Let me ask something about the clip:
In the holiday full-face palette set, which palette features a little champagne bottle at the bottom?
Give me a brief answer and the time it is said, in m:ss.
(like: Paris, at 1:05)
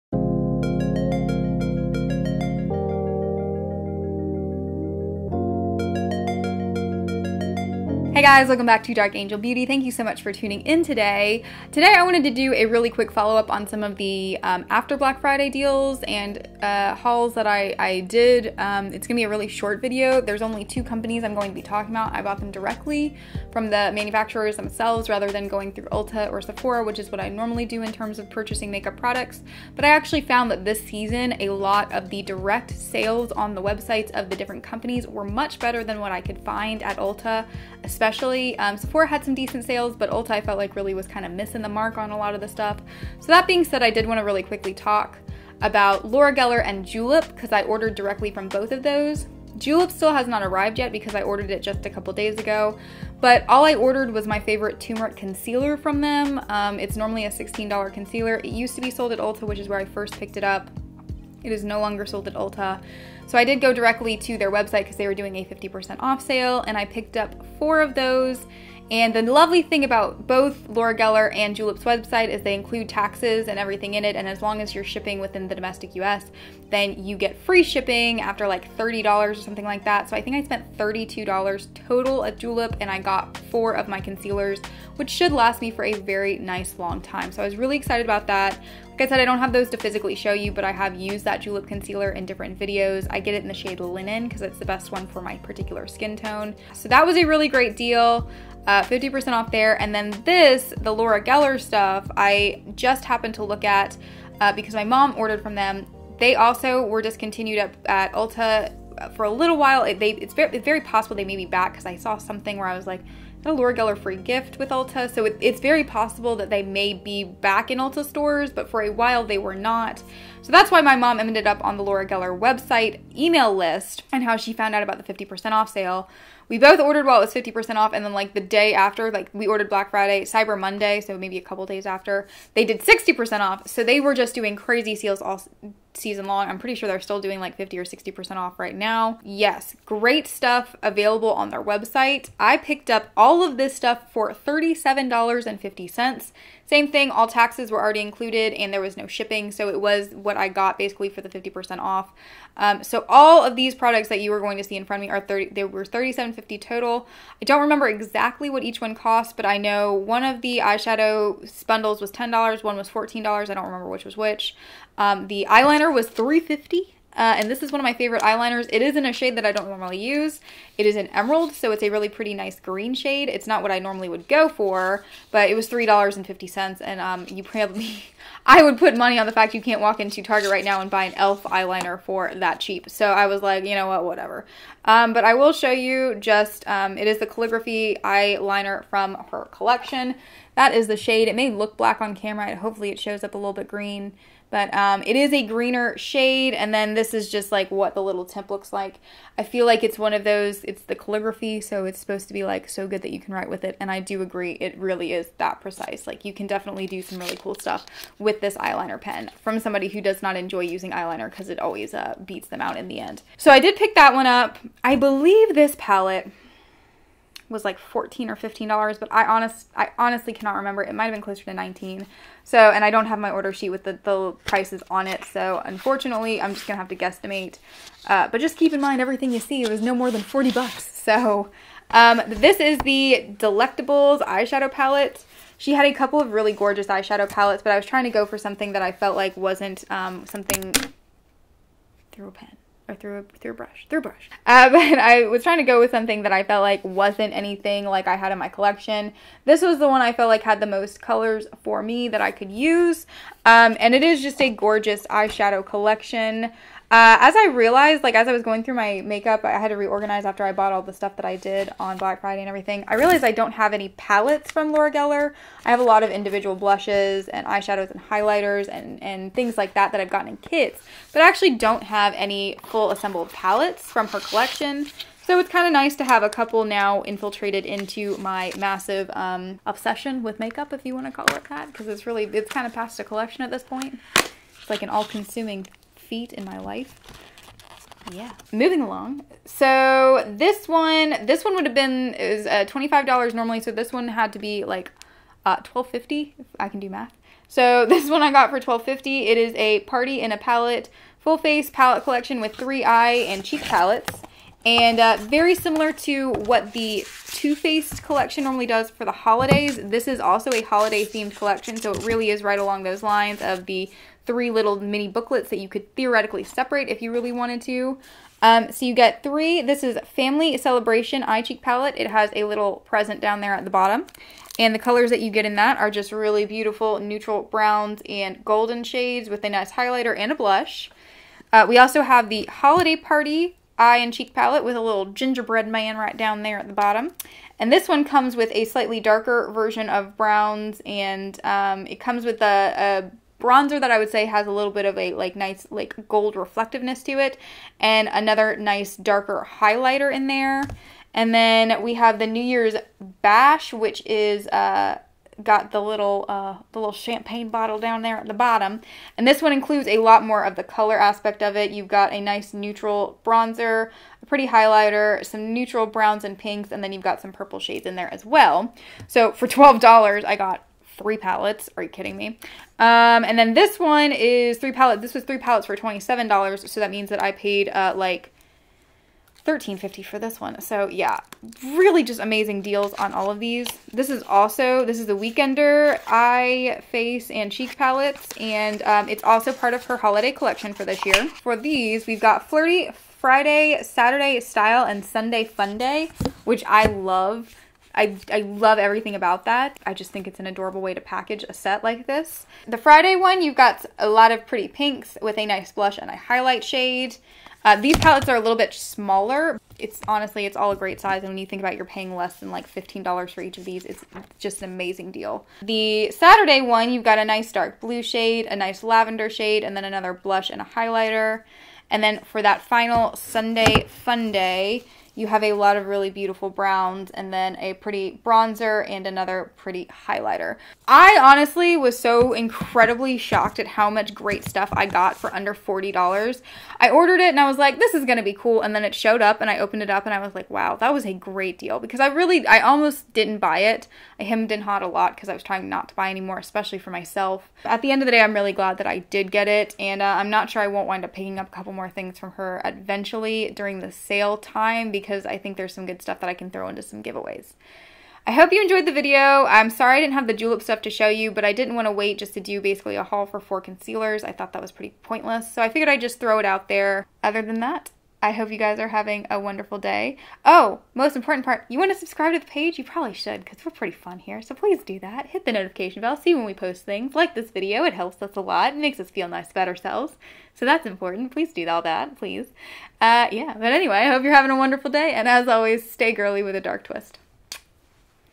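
New Year's Bash, at 5:52.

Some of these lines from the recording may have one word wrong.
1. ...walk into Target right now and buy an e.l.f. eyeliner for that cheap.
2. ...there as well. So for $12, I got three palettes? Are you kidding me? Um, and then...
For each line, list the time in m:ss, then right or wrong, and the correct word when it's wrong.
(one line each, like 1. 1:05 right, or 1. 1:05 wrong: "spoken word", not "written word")
1. 2:59 right
2. 6:07 right.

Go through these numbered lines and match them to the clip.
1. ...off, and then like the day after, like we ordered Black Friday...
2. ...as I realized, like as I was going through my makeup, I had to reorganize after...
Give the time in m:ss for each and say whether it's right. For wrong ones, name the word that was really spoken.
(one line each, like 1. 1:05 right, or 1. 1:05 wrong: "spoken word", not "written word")
1. 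2:07 right
2. 4:17 right.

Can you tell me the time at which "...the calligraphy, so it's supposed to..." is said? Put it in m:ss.
3:20.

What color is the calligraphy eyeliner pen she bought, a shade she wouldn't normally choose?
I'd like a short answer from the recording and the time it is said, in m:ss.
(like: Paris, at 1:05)
Emerald, at 2:51.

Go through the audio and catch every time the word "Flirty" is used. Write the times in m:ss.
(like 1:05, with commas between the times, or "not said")
6:32.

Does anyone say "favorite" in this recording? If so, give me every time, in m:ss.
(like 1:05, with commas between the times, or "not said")
0:54, 2:47.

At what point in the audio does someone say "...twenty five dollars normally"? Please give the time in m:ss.
4:52.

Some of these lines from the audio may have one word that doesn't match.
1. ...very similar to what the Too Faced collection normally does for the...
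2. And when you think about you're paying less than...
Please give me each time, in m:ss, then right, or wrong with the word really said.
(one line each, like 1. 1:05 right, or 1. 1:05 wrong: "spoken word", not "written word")
1. 5:05 right
2. 6:51 right.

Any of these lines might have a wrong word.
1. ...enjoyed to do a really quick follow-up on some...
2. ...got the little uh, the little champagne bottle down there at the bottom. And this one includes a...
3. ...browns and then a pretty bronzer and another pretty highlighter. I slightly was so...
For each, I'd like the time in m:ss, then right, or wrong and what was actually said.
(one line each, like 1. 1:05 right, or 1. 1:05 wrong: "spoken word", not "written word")
1. 0:12 wrong: "wanted", not "enjoyed"
2. 5:55 right
3. 7:06 wrong: "honestly", not "slightly".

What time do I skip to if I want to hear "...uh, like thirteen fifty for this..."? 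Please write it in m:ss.
6:17.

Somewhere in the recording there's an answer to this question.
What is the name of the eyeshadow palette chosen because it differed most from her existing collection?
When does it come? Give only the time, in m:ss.
3:53.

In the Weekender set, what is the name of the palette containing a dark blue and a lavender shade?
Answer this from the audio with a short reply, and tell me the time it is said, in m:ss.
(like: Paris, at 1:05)
Saturday Style, at 6:33.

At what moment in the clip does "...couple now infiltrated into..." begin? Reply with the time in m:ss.
4:36.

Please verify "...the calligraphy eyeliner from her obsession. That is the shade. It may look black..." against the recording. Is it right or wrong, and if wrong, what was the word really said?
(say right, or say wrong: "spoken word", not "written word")
wrong: "collection", not "obsession".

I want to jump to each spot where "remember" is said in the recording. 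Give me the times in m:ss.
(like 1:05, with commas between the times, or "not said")
2:37, 2:43, 3:40.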